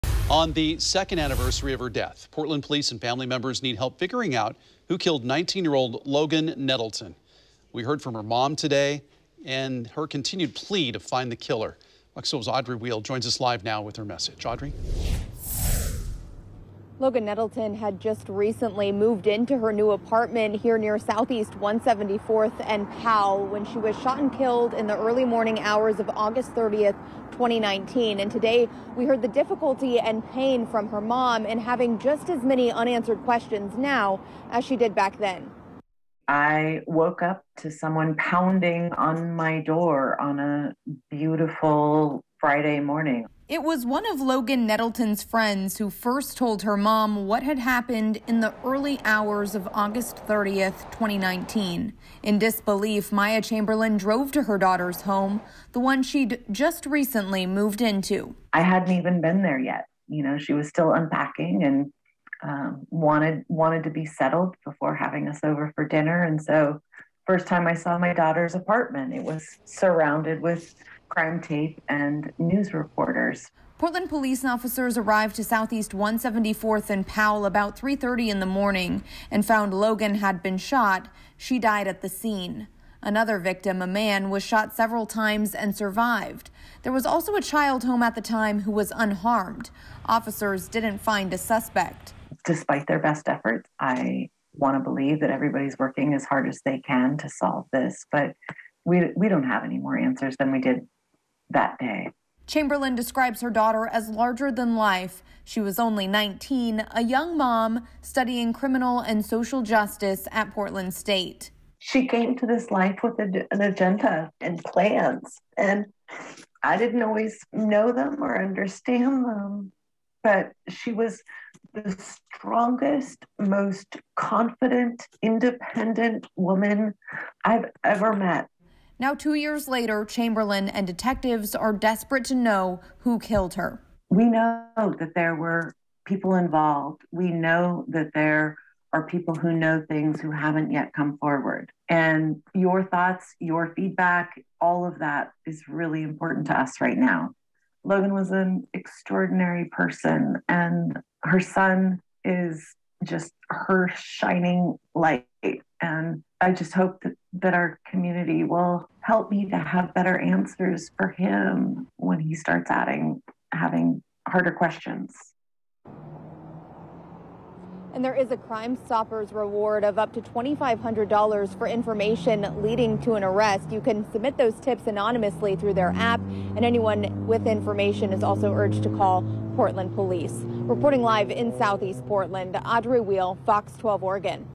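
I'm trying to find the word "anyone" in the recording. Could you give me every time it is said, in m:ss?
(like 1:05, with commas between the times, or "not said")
2:56.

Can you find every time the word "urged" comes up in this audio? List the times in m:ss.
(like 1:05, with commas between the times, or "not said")
2:58.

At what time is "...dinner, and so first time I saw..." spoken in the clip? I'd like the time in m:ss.
1:05.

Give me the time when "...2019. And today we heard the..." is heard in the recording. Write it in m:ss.
0:27.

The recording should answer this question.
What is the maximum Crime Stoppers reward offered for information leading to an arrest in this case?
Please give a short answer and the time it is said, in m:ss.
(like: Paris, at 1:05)
$2,500, at 2:50.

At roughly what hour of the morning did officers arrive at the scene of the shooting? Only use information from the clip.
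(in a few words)
3:30.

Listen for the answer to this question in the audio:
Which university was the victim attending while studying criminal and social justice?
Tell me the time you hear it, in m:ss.
1:50.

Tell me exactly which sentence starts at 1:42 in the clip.
Chamberlain describes her daughter as larger than life.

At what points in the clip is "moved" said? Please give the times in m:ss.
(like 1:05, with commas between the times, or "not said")
0:18, 0:57.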